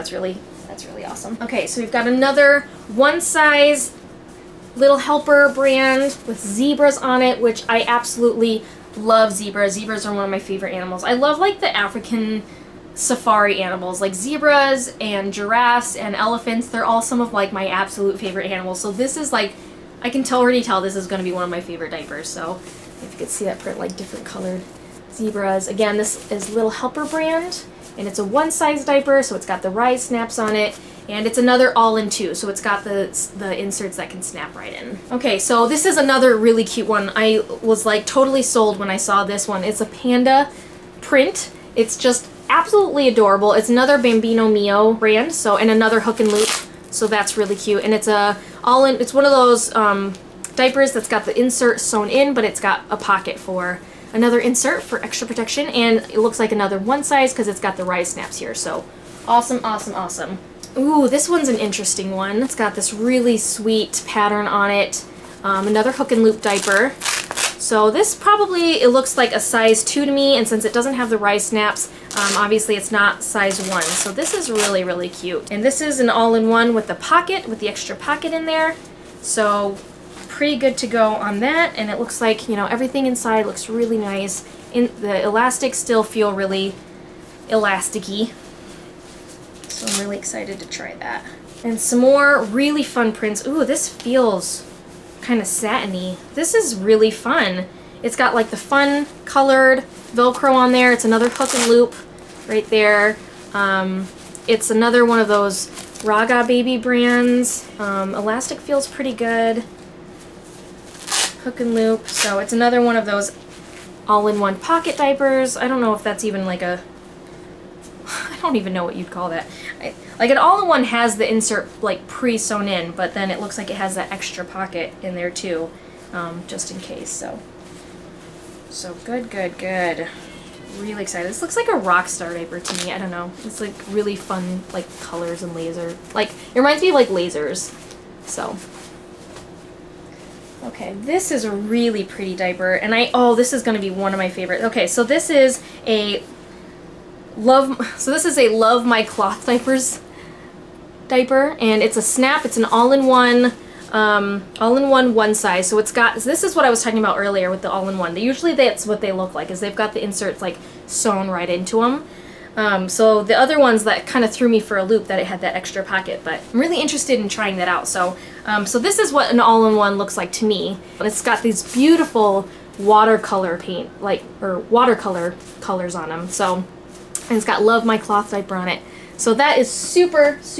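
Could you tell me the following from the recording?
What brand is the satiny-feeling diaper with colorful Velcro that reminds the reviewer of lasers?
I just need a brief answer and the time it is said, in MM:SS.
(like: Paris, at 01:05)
Raga baby, at 01:46.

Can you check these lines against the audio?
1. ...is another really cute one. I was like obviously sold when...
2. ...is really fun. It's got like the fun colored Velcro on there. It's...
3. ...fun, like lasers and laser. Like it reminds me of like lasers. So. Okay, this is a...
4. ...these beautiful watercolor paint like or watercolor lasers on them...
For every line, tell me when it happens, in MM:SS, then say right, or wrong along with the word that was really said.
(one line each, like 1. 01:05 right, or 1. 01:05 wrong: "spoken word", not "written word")
1. 00:35 wrong: "totally", not "obviously"
2. 01:36 right
3. 02:14 wrong: "colors", not "lasers"
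4. 02:51 wrong: "colors", not "lasers".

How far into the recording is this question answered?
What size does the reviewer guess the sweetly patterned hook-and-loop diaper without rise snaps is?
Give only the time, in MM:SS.
01:09.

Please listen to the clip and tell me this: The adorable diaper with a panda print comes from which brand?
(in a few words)
Bambino Mio.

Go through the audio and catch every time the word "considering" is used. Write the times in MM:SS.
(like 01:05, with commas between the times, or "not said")
not said.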